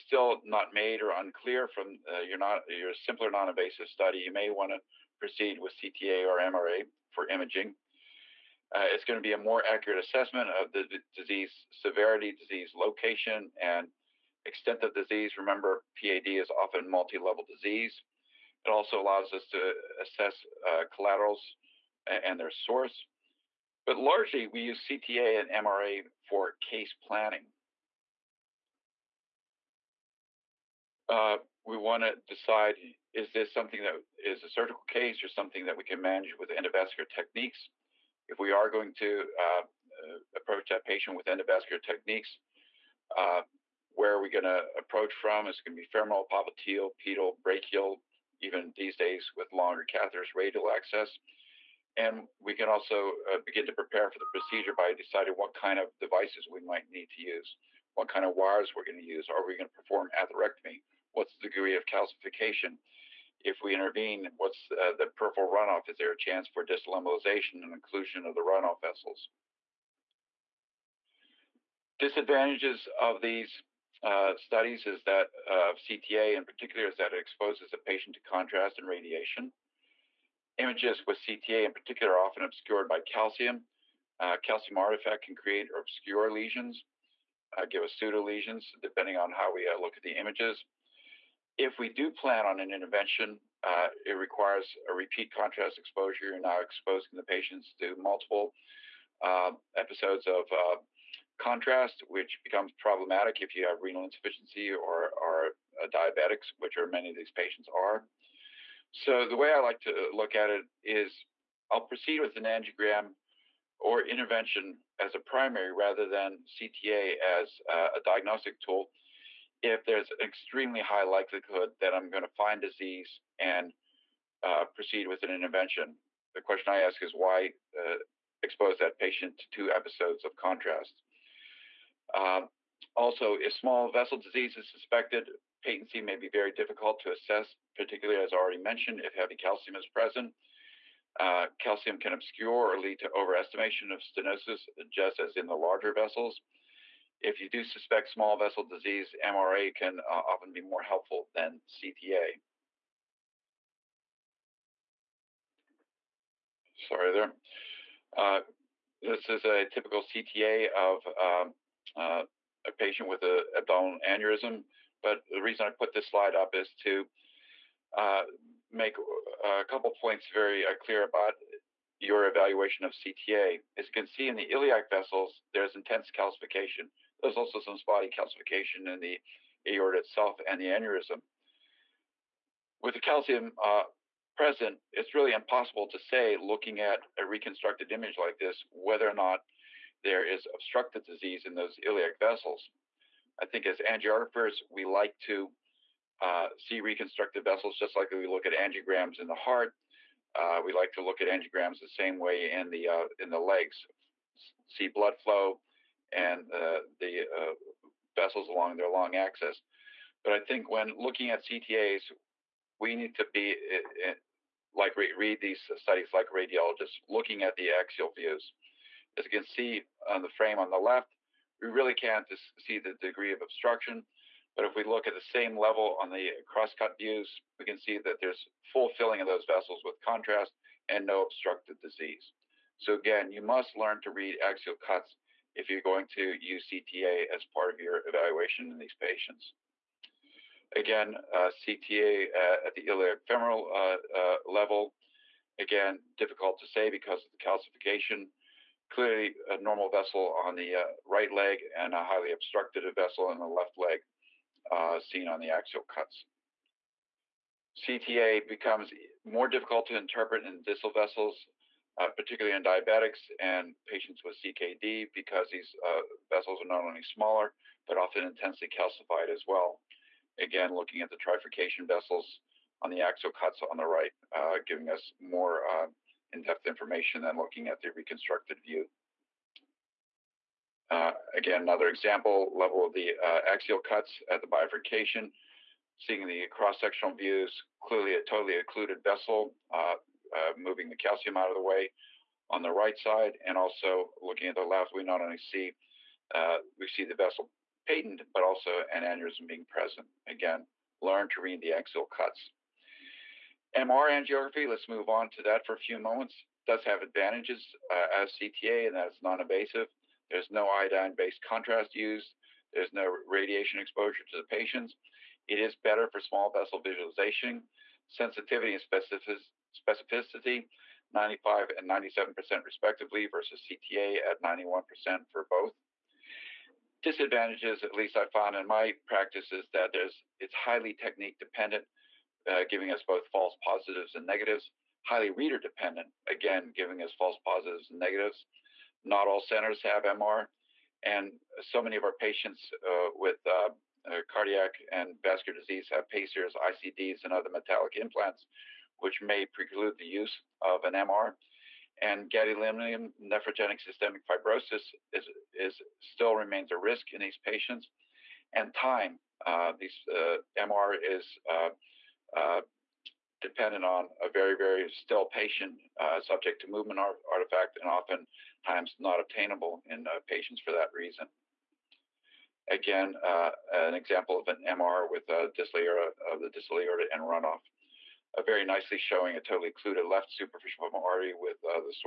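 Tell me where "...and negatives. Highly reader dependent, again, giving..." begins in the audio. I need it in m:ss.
5:34.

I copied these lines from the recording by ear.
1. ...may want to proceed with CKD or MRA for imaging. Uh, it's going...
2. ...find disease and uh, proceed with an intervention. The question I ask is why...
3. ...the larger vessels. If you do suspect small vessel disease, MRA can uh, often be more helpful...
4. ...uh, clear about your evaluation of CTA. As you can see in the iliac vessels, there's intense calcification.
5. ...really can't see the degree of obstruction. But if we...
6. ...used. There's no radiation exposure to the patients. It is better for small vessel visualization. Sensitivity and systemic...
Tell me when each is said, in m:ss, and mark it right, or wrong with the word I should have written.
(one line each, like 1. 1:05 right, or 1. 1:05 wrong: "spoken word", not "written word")
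1. 0:04 wrong: "CTA", not "CKD"
2. 2:02 right
3. 2:25 right
4. 2:50 right
5. 3:41 right
6. 5:11 wrong: "specific", not "systemic".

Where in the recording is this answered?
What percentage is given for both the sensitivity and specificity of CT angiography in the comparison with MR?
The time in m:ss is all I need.
5:24.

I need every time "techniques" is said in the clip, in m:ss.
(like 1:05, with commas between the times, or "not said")
0:37, 0:41, 5:30.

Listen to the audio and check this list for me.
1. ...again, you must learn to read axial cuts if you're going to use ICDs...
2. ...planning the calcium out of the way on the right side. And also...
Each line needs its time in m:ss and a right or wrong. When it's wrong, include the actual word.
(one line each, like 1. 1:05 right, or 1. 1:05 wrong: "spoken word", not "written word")
1. 3:52 wrong: "CTA", not "ICDs"
2. 4:50 wrong: "moving", not "planning".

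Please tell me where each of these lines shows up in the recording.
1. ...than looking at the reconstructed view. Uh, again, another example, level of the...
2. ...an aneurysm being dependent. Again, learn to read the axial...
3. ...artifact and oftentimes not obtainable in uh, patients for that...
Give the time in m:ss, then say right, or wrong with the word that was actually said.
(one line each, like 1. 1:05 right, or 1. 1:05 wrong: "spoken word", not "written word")
1. 4:37 right
2. 4:58 wrong: "present", not "dependent"
3. 6:06 right.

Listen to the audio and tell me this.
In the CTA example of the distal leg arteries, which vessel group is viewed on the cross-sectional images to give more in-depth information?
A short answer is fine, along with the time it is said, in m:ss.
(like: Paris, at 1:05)
trifurcation vessels, at 4:31.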